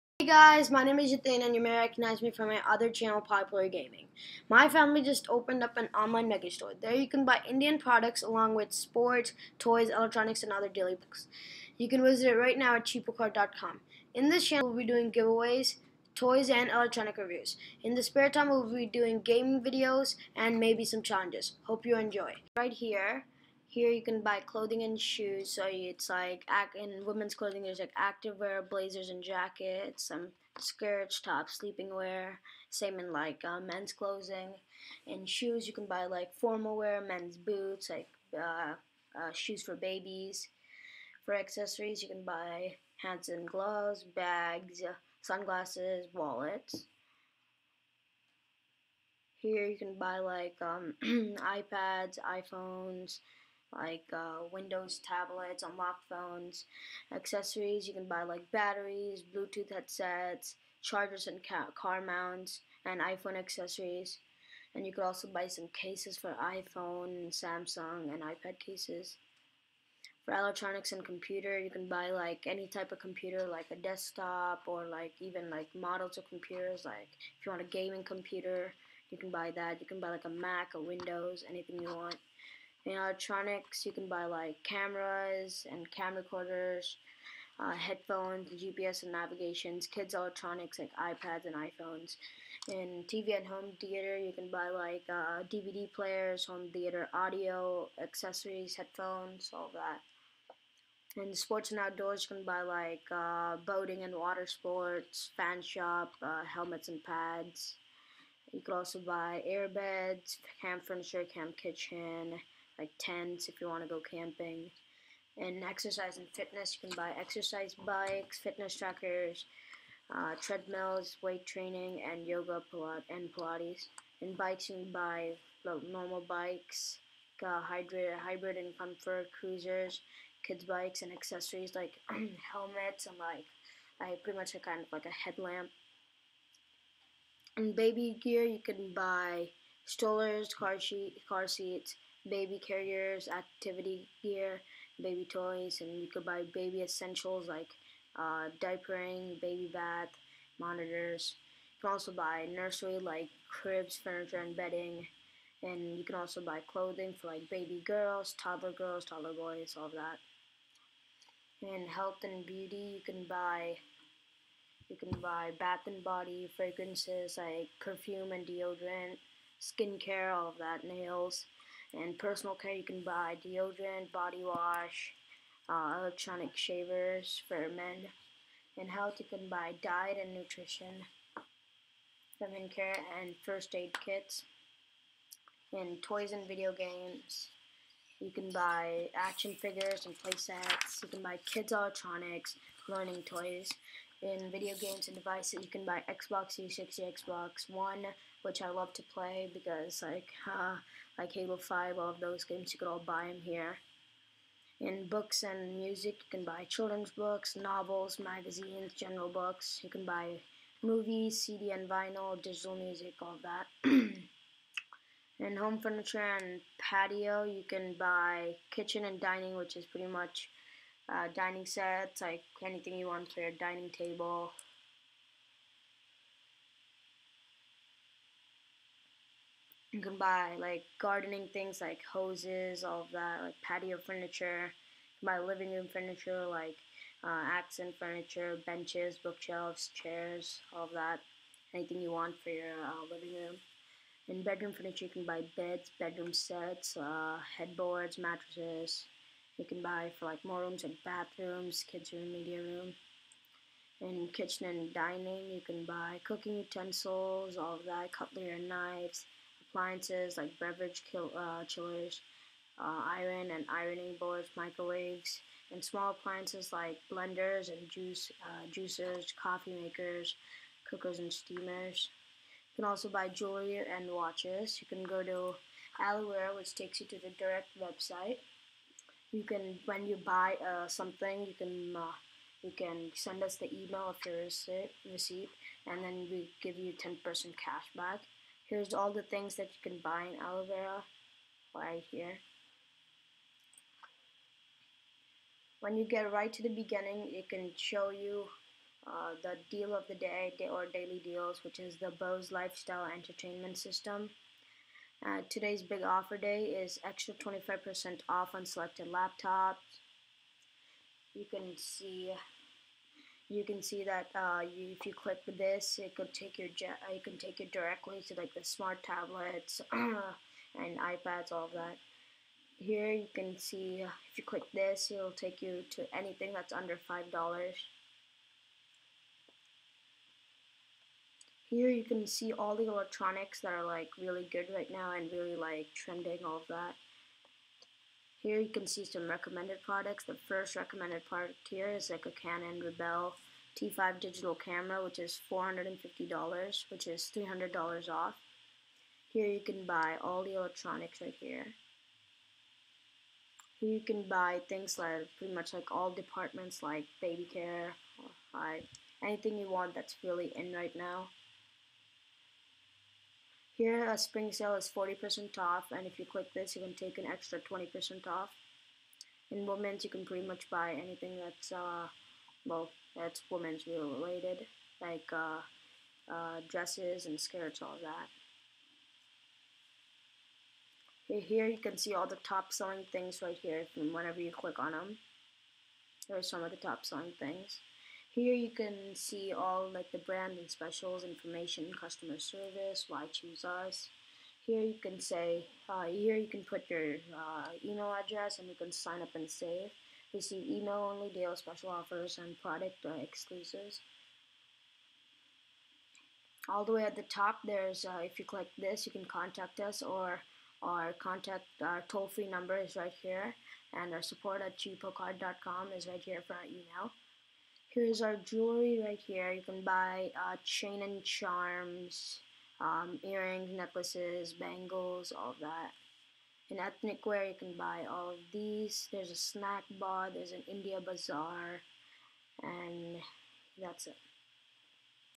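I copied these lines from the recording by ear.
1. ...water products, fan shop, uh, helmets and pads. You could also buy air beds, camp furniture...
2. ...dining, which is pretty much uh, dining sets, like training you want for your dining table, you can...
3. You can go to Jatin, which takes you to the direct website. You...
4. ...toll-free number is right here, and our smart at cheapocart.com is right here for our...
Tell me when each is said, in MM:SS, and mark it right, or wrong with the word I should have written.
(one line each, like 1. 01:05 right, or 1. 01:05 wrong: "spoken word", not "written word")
1. 01:44 wrong: "sports", not "products"
2. 03:39 wrong: "anything", not "training"
3. 04:34 wrong: "Alloware", not "Jatin"
4. 06:52 wrong: "support", not "smart".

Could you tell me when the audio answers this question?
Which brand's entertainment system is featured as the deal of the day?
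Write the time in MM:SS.
05:02.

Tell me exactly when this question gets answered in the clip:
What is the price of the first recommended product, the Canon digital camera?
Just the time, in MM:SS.
05:45.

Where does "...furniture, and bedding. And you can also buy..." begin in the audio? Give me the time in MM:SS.
02:33.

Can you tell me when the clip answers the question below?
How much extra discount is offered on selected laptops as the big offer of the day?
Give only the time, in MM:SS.
05:07.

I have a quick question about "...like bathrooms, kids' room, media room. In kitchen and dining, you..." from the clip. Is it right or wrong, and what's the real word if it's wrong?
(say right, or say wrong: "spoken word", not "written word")
right.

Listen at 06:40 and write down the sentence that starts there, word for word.
Receive email only deals, special offers, and product uh, exclusives.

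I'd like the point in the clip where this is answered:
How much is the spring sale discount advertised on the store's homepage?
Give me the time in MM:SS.
06:04.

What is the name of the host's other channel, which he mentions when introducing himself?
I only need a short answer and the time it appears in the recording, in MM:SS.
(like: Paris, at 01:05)
Popular Gaming, at 00:03.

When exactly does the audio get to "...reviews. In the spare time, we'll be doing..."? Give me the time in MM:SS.
00:17.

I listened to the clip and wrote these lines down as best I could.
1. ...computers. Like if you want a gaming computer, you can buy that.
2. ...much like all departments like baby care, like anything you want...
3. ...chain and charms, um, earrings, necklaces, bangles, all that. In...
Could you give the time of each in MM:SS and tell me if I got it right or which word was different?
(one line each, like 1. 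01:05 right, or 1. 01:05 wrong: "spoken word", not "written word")
1. 01:16 right
2. 05:55 right
3. 07:00 right.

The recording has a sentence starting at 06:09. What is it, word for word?
In women's you can pretty much buy anything that's uh, well that's women's related like uh, uh, dresses and skirts all that.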